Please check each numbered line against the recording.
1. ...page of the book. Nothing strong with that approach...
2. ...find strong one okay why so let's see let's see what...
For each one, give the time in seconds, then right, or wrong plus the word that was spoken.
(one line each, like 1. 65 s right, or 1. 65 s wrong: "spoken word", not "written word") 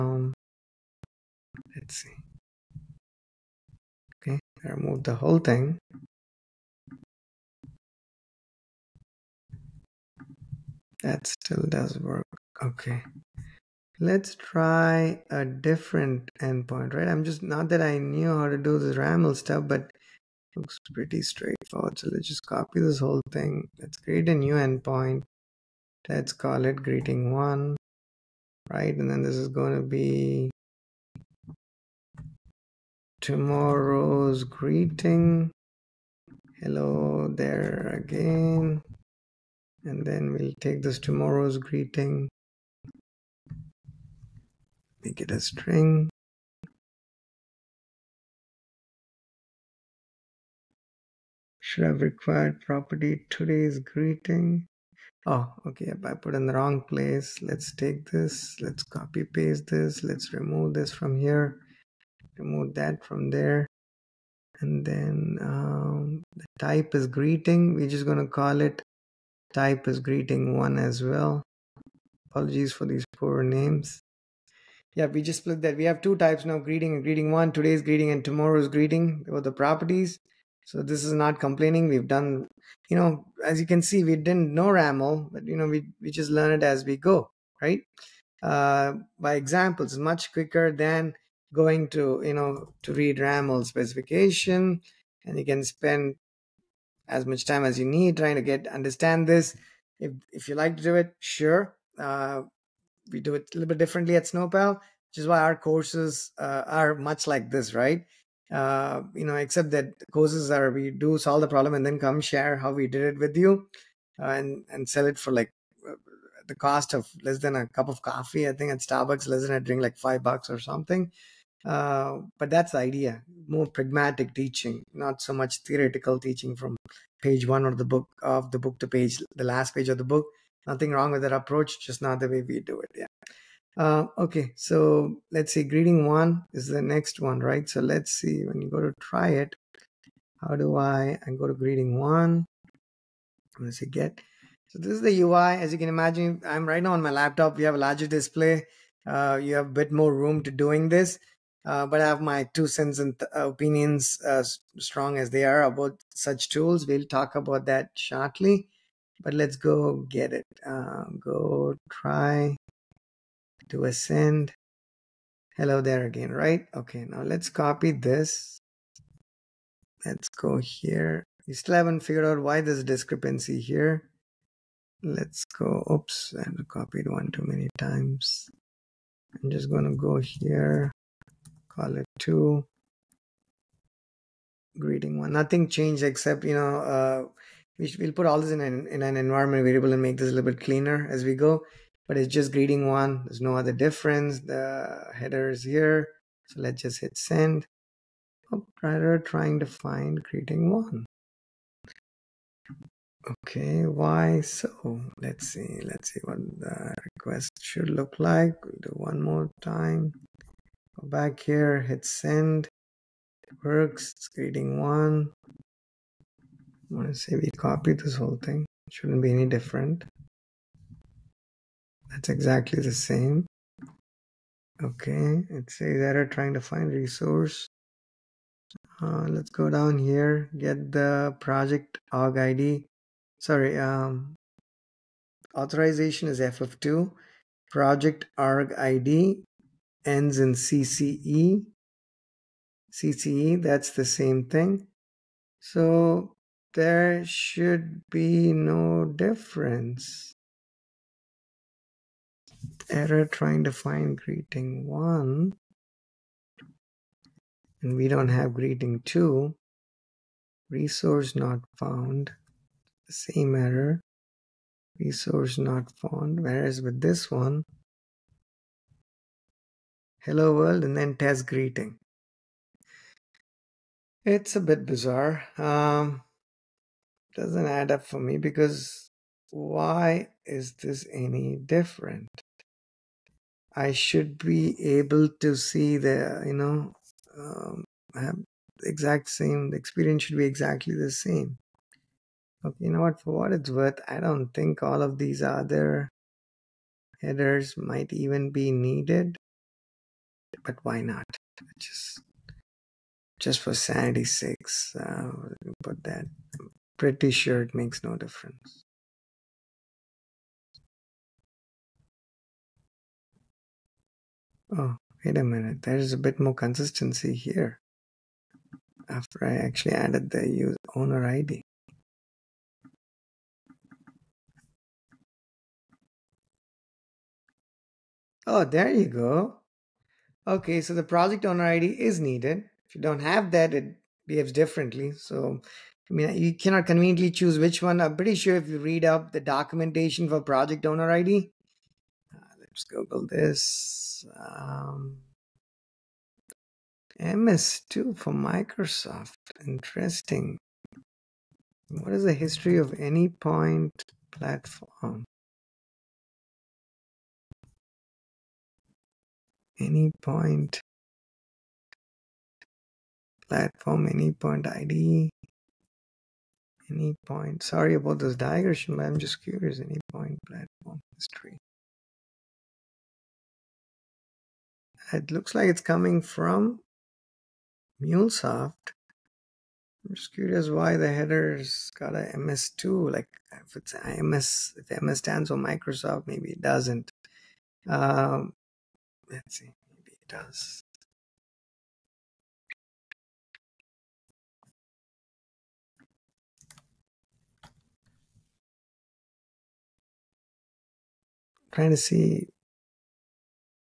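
1. 129 s wrong: "wrong", not "strong"
2. 199 s wrong: "greeting", not "strong".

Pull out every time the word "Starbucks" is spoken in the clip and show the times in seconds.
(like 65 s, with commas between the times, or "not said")
118 s.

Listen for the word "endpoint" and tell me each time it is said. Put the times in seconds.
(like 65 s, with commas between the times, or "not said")
16 s, 24 s.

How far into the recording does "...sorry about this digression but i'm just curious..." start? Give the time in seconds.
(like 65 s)
367 s.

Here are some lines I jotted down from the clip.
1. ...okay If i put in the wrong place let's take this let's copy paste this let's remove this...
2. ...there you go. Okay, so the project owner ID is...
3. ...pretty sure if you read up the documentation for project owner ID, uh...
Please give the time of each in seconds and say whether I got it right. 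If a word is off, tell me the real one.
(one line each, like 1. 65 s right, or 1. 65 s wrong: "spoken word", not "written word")
1. 55 s right
2. 328 s right
3. 338 s right.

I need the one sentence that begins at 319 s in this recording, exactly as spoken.
After I actually added the user owner ID.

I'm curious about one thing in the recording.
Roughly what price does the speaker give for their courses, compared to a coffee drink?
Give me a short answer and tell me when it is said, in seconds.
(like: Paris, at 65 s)
5 bucks, at 119 s.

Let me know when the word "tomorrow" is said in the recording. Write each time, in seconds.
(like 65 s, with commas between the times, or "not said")
33 s, 40 s, 78 s.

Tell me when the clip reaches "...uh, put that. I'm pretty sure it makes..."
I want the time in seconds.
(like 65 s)
304 s.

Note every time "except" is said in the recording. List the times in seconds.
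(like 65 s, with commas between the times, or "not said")
109 s, 186 s.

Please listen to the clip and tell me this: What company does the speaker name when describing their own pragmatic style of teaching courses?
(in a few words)
Snowpal.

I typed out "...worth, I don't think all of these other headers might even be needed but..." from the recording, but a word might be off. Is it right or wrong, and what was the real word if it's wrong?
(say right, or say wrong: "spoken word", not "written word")
right.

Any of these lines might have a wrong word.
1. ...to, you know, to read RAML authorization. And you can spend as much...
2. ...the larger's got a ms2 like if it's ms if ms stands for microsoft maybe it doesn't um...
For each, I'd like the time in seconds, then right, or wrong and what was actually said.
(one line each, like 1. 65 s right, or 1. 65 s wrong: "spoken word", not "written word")
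1. 91 s wrong: "specification", not "authorization"
2. 380 s wrong: "header", not "larger".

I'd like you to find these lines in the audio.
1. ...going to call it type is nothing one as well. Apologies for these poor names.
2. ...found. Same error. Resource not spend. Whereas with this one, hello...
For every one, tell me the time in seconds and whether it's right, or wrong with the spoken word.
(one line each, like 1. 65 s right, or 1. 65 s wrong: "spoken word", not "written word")
1. 68 s wrong: "greeting", not "nothing"
2. 261 s wrong: "found", not "spend".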